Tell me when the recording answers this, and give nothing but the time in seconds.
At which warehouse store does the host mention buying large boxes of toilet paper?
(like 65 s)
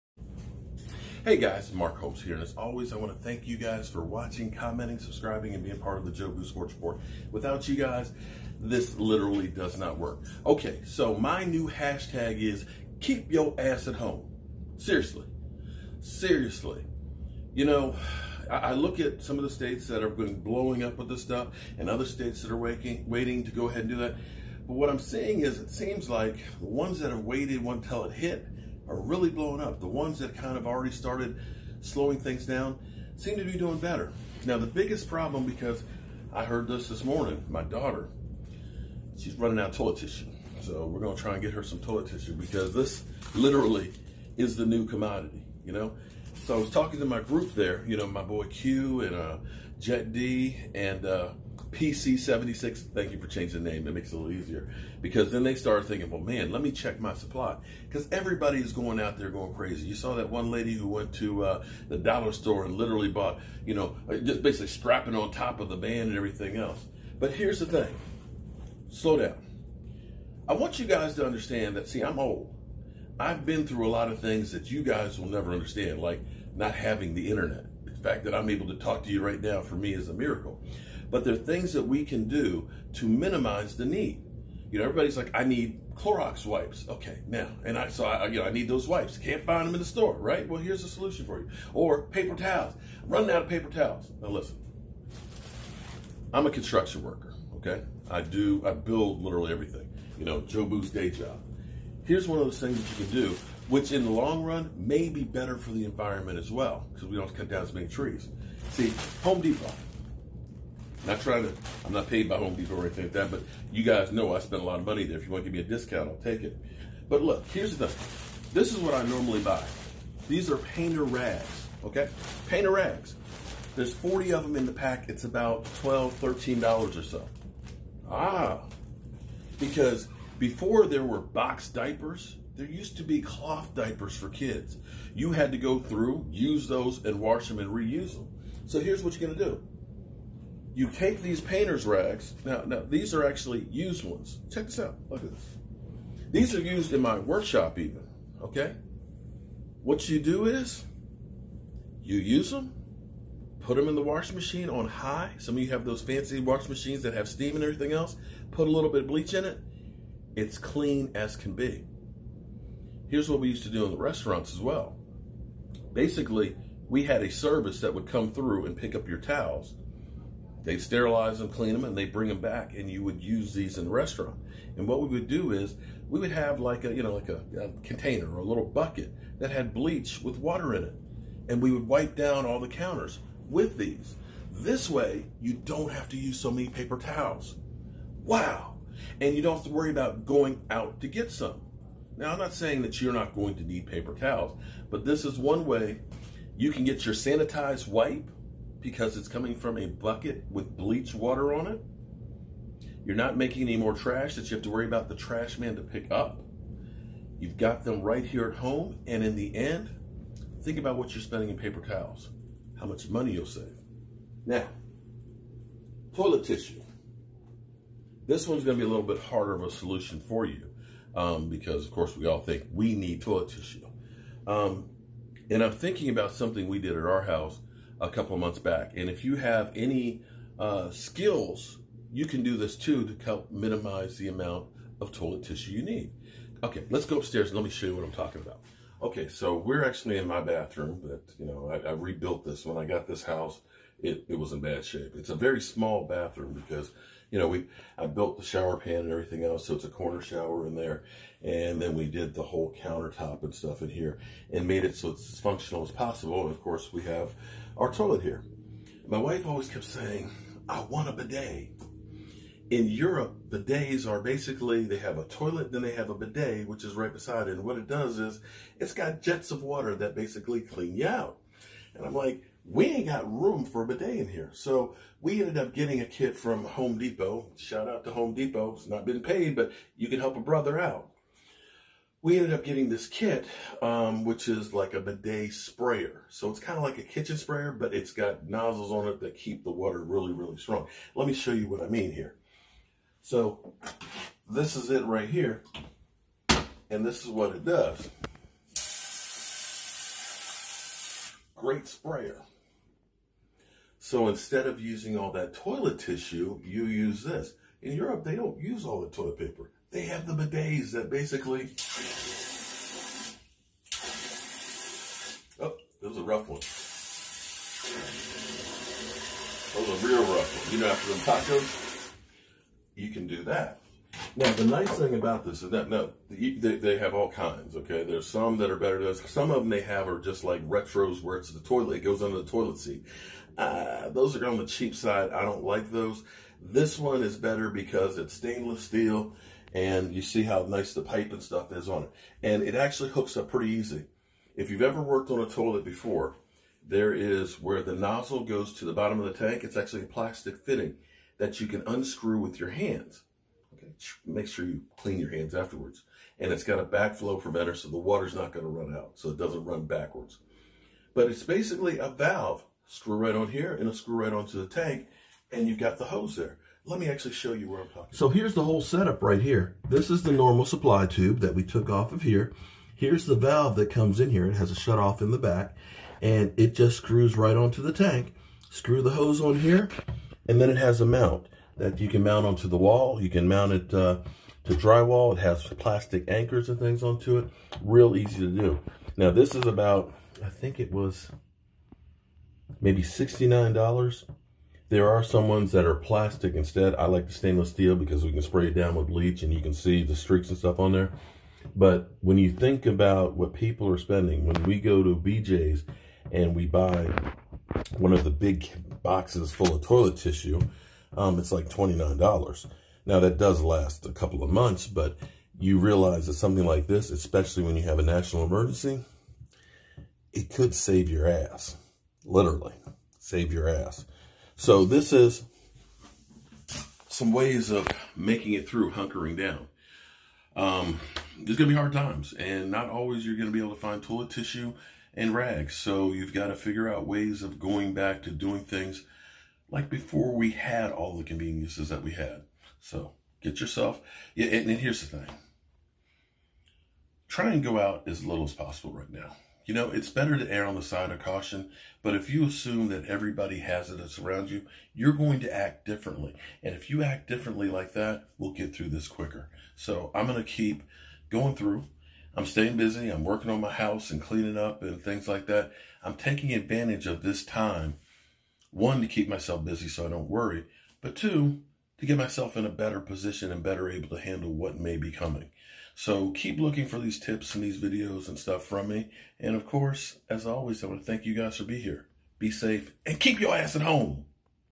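405 s.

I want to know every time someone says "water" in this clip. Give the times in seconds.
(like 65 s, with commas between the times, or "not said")
180 s, 201 s, 269 s, 289 s, 357 s.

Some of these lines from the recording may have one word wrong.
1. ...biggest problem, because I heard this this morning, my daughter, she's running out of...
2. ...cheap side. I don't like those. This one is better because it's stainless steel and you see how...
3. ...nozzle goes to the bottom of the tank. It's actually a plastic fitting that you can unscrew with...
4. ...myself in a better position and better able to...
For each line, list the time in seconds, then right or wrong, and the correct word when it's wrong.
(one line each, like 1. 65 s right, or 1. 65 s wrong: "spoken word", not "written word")
1. 34 s right
2. 334 s right
3. 347 s right
4. 472 s right.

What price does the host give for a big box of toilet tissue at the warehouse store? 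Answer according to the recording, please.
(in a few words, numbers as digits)
$29.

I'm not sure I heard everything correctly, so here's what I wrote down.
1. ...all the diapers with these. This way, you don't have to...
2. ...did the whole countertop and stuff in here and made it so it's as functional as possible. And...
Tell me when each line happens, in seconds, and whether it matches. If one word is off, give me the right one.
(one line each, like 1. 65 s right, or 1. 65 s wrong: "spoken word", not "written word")
1. 182 s wrong: "counters", not "diapers"
2. 252 s right.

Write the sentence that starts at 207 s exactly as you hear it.
You've got them right here at home.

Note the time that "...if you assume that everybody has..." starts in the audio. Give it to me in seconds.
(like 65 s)
452 s.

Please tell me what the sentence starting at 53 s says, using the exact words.
It makes it a little easier.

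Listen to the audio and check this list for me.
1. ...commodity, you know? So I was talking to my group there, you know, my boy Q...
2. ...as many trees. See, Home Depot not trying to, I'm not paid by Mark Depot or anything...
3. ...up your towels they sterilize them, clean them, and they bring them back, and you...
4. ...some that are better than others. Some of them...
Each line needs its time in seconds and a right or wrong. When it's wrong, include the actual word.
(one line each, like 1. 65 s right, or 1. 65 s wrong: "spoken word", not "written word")
1. 44 s right
2. 107 s wrong: "Home", not "Mark"
3. 168 s right
4. 328 s right.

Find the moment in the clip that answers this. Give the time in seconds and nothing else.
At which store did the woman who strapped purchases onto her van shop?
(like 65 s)
61 s.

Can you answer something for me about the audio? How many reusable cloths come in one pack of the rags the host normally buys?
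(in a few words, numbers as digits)
40.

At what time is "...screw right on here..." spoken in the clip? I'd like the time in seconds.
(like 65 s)
362 s.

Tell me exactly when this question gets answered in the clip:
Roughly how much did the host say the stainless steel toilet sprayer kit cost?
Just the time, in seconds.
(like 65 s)
393 s.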